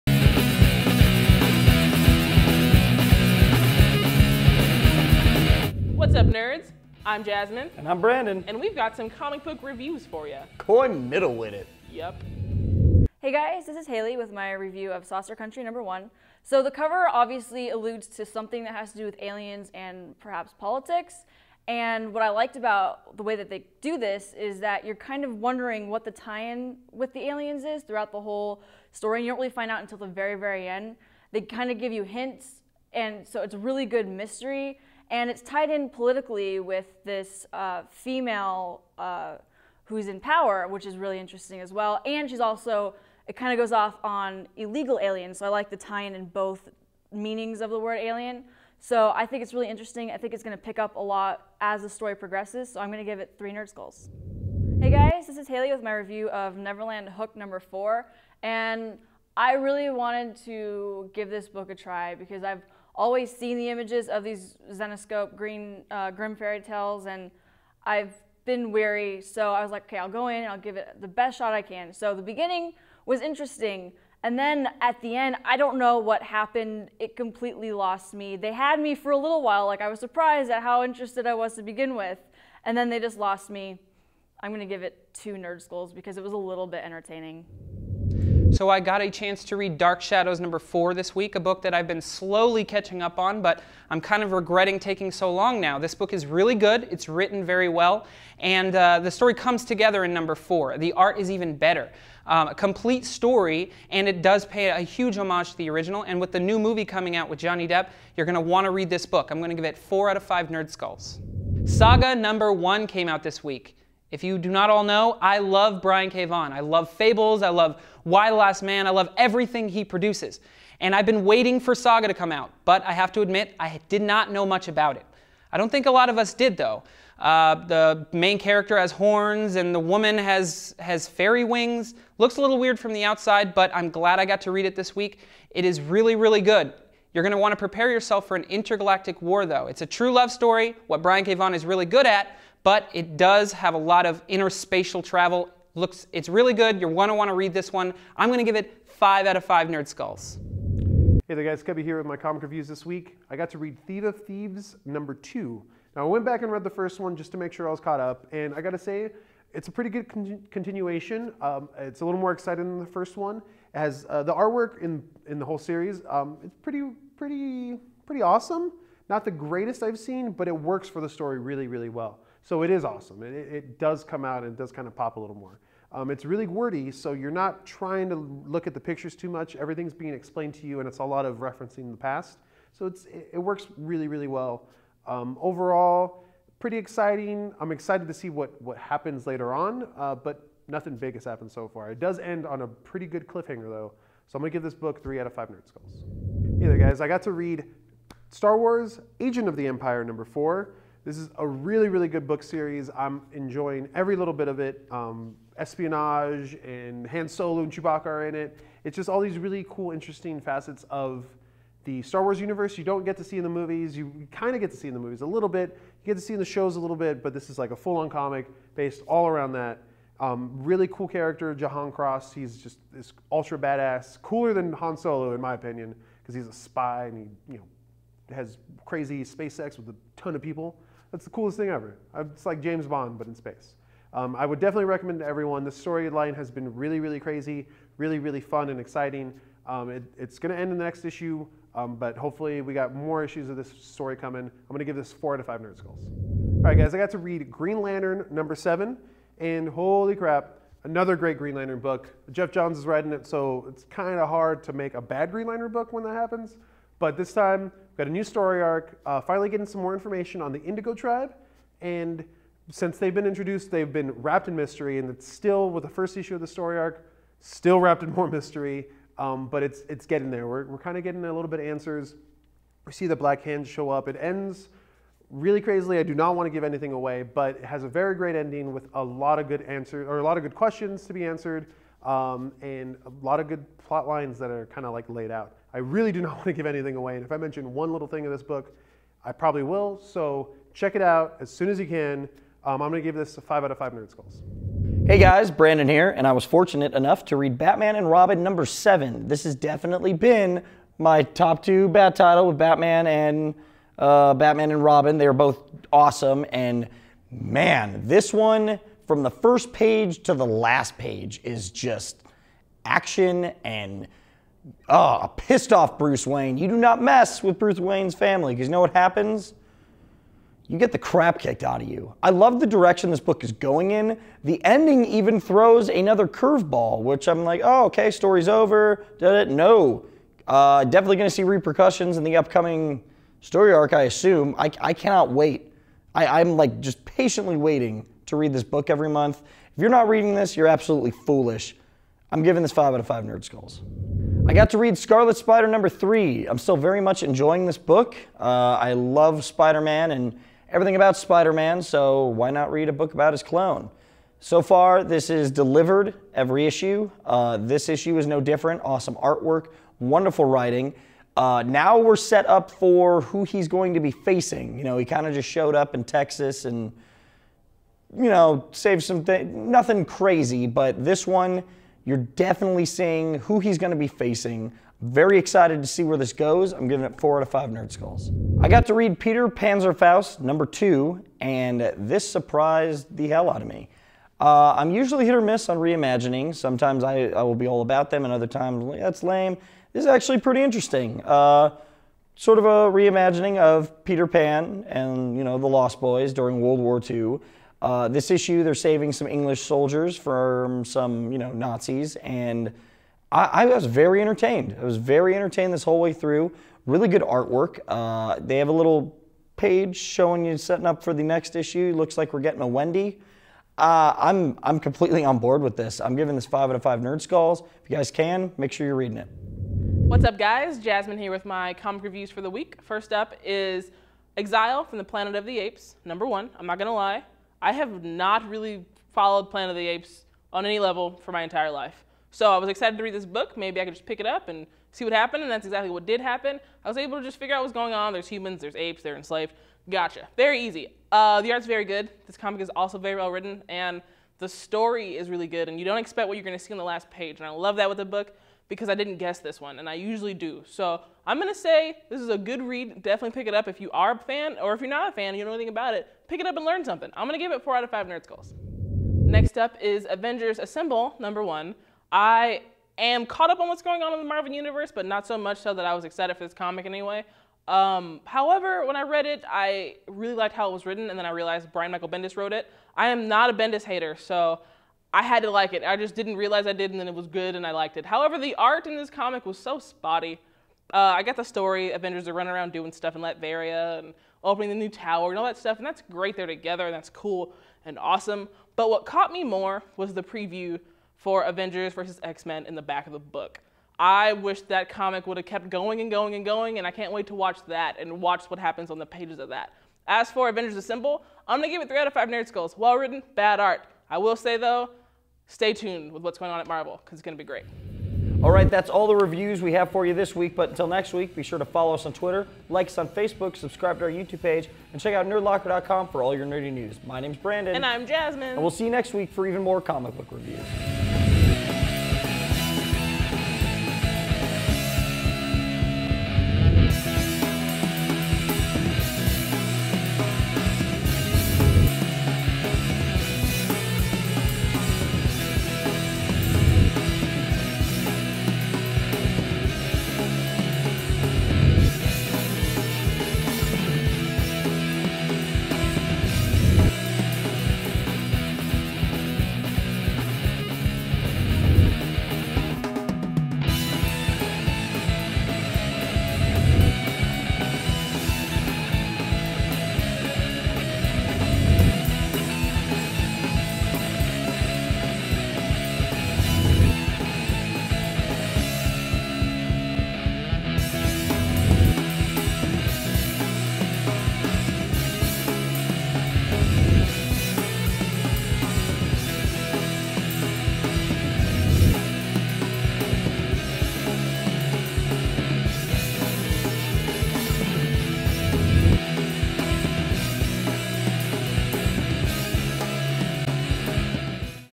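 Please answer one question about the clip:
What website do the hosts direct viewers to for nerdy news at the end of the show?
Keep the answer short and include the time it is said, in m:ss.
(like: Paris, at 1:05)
nerdlocker.com, at 8:35.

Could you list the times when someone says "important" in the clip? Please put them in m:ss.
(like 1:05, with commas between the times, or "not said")
not said.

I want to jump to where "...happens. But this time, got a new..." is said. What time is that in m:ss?
4:16.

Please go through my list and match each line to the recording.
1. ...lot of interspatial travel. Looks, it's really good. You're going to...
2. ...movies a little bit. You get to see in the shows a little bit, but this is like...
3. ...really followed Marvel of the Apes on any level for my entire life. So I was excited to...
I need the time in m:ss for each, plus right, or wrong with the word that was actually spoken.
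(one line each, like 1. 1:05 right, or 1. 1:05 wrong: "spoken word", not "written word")
1. 2:23 right
2. 3:34 right
3. 7:08 wrong: "Planet", not "Marvel".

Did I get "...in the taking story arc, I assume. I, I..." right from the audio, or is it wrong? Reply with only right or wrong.
wrong.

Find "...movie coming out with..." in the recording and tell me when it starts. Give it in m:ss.
1:46.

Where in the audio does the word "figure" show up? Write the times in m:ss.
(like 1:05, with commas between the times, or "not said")
7:17.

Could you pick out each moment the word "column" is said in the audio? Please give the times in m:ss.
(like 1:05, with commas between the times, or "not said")
not said.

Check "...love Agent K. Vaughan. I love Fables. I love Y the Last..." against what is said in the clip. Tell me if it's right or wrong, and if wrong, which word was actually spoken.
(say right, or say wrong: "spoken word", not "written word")
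wrong: "Brian", not "Agent".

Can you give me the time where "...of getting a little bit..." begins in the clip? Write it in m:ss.
4:30.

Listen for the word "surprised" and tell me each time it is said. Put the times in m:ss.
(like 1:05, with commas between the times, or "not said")
1:19, 6:22.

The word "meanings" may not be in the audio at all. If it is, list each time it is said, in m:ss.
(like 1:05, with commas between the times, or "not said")
0:47.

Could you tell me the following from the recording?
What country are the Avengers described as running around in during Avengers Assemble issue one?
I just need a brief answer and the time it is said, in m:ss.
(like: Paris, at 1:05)
Latveria, at 8:03.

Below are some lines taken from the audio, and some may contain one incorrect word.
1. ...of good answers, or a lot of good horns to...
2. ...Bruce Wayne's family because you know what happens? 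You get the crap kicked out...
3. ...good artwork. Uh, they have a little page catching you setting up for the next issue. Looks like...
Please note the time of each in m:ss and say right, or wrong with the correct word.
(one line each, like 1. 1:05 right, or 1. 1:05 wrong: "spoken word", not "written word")
1. 4:39 wrong: "questions", not "horns"
2. 5:17 right
3. 6:47 wrong: "showing", not "catching".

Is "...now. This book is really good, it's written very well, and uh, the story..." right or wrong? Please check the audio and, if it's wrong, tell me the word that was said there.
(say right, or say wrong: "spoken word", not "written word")
right.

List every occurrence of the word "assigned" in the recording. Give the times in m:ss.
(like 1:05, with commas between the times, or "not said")
not said.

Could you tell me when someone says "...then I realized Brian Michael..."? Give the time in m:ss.
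7:51.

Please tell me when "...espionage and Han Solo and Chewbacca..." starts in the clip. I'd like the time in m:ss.
3:25.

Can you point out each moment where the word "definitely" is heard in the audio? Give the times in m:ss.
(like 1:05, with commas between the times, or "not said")
3:54, 4:59, 5:30, 6:12, 7:33.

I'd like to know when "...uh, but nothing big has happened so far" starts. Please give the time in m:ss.
3:09.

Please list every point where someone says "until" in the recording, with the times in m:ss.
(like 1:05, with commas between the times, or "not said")
0:29, 8:30.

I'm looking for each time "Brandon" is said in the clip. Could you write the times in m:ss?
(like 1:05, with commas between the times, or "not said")
0:08, 4:55, 8:37.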